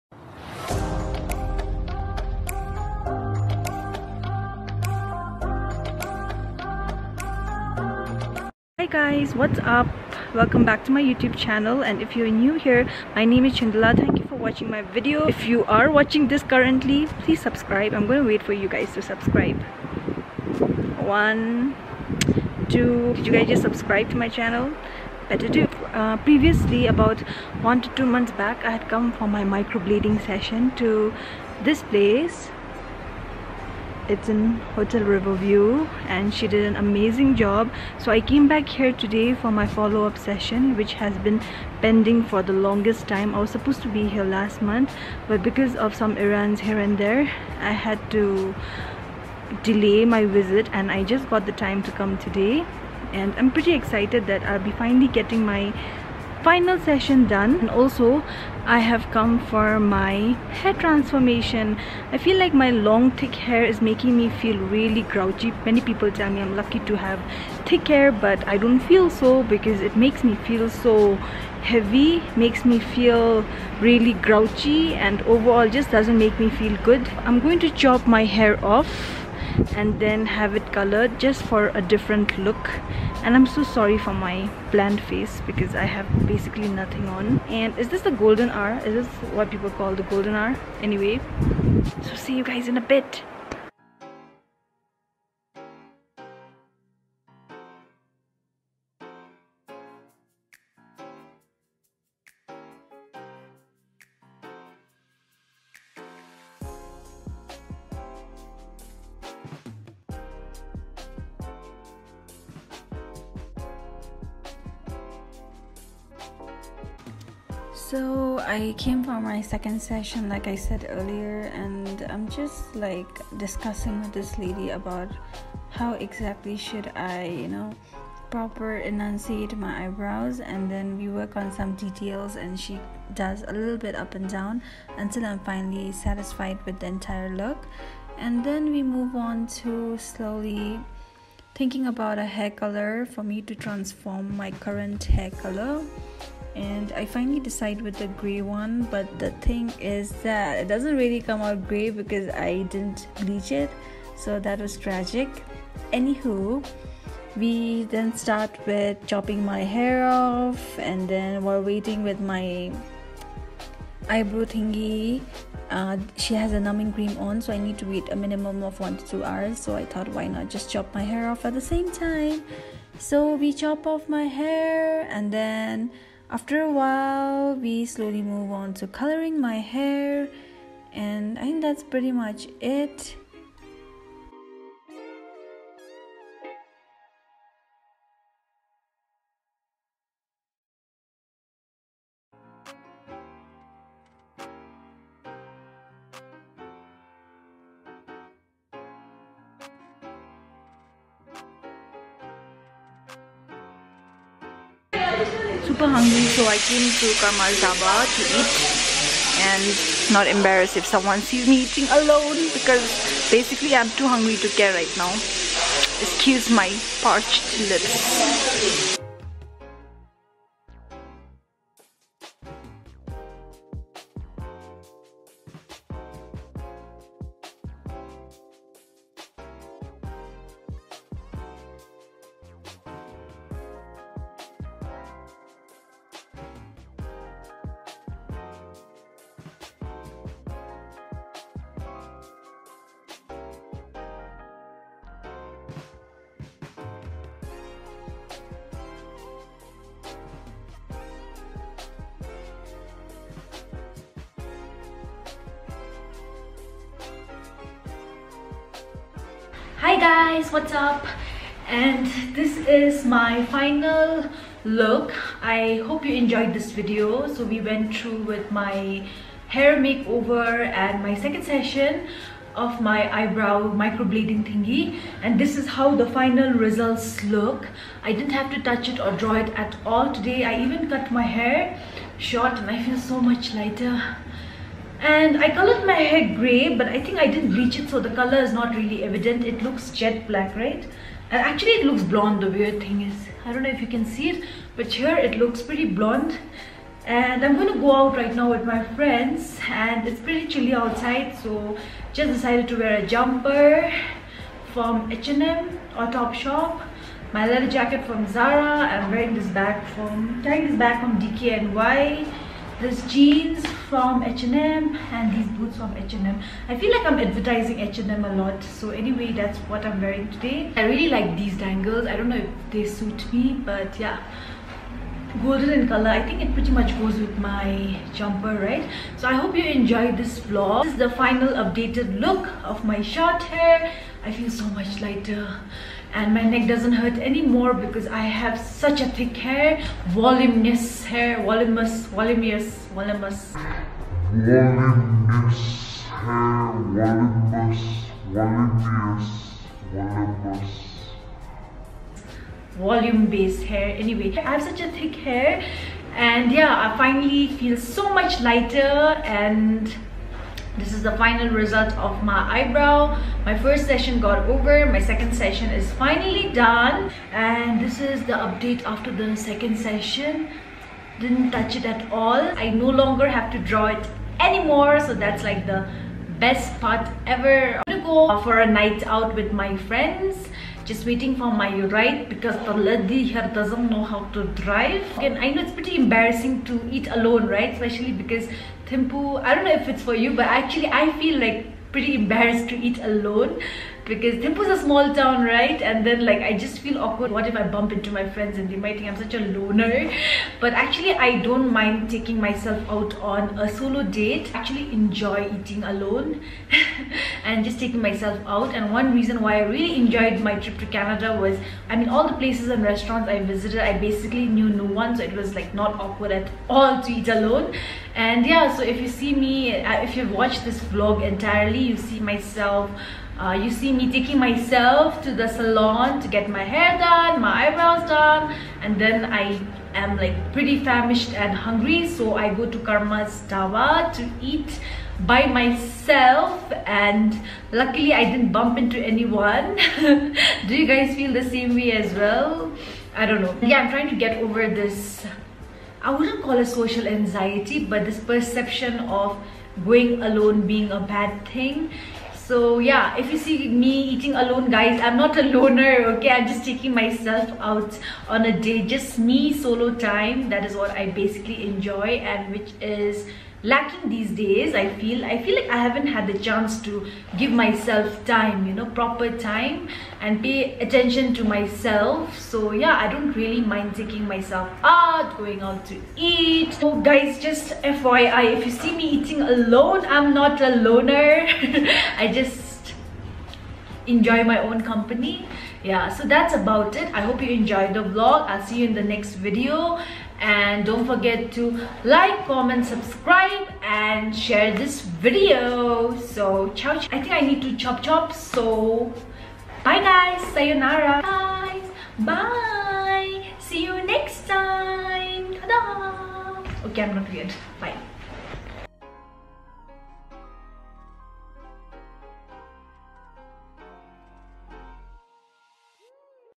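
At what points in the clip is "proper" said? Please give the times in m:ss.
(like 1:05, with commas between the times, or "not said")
2:08, 7:48.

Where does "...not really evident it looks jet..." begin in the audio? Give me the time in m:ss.
4:48.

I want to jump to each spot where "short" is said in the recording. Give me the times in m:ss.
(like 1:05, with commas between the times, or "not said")
4:42, 5:33.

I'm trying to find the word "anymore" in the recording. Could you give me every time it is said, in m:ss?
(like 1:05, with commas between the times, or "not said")
5:37, 6:14.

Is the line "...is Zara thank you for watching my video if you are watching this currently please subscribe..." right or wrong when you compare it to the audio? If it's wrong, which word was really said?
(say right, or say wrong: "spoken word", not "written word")
wrong: "Chundhala", not "Zara".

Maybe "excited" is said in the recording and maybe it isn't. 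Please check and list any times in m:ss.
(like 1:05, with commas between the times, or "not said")
0:53.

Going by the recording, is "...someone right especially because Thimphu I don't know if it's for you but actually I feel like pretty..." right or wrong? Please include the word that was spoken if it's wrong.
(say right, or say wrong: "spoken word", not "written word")
wrong: "alone", not "someone".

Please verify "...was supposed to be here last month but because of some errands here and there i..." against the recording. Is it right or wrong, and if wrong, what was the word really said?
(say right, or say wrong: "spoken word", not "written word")
right.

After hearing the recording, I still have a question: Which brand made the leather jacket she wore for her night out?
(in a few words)
Zara.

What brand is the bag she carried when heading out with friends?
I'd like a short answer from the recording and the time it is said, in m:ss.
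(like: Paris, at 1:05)
DKNY, at 5:11.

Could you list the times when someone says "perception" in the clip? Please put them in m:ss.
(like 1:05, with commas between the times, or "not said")
7:28.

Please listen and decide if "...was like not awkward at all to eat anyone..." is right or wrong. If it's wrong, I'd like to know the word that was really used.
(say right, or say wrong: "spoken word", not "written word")
wrong: "alone", not "anyone".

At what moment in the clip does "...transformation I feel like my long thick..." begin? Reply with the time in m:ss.
1:00.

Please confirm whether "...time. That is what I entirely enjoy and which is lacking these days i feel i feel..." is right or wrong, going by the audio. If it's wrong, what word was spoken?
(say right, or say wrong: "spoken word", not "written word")
wrong: "basically", not "entirely".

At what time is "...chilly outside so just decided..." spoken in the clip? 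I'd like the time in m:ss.
5:00.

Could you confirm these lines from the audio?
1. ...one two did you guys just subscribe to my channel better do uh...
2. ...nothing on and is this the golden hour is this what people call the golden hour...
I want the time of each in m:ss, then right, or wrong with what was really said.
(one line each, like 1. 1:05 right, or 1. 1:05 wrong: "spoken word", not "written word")
1. 0:21 right
2. 1:26 right.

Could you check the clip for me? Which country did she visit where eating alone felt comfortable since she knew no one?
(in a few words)
Canada.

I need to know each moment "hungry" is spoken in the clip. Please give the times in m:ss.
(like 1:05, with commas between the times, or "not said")
3:25, 3:34, 7:11.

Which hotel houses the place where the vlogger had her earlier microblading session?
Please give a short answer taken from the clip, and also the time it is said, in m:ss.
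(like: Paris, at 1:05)
Hotel Riverview, at 0:34.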